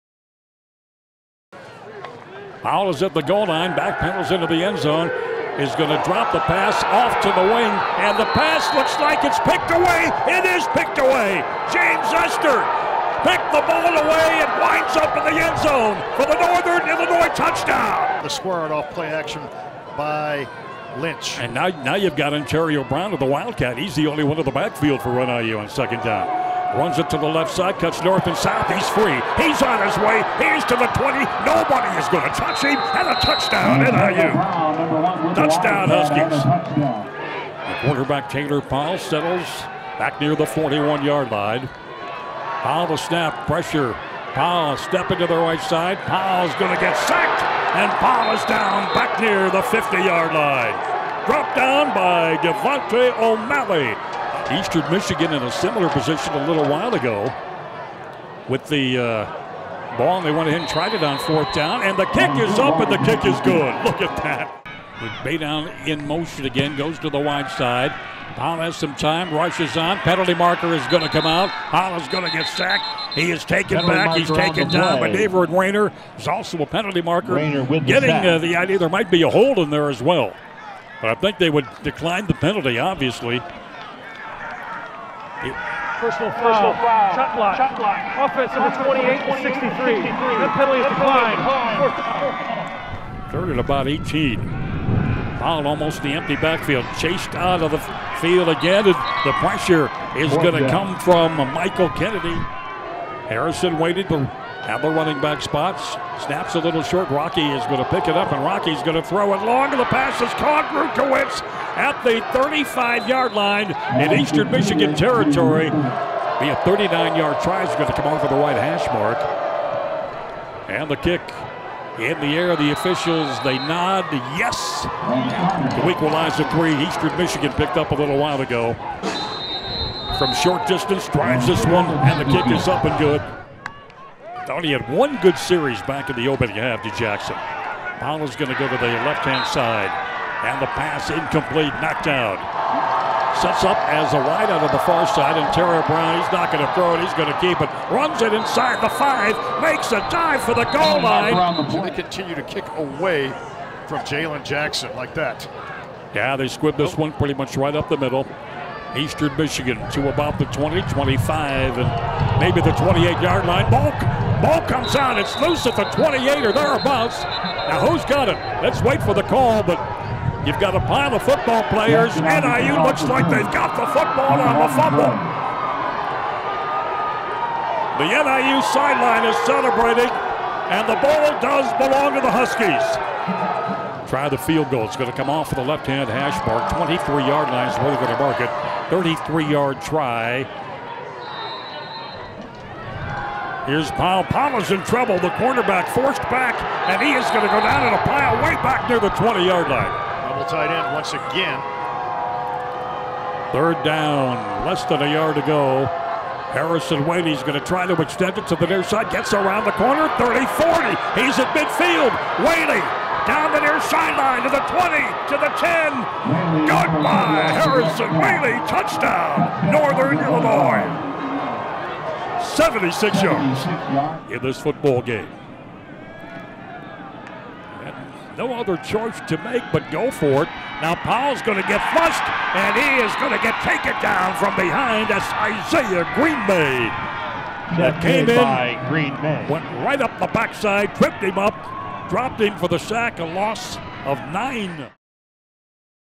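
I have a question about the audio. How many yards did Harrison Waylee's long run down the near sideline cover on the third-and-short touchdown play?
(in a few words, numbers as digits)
76.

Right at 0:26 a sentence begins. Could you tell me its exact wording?
Runs it to the left side, cuts north and south.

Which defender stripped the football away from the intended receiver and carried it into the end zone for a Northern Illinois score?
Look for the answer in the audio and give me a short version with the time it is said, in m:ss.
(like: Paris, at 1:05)
James Ester, at 0:11.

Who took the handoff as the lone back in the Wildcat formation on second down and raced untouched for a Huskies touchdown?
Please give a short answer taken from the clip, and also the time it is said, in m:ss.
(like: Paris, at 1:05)
Antario Brown, at 0:22.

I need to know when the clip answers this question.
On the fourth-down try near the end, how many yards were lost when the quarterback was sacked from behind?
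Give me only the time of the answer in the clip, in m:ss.
4:03.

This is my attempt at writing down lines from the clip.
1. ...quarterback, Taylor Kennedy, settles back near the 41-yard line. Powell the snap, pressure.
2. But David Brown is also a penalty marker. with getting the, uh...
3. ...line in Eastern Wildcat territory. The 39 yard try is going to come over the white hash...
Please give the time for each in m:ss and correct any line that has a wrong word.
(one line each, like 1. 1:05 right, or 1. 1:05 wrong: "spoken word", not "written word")
1. 0:37 wrong: "Powell", not "Kennedy"
2. 1:14 wrong: "Rayner", not "Brown"
3. 1:53 wrong: "Michigan", not "Wildcat".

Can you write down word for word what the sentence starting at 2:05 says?
The equalizer three Eastern Michigan picked up a little while ago.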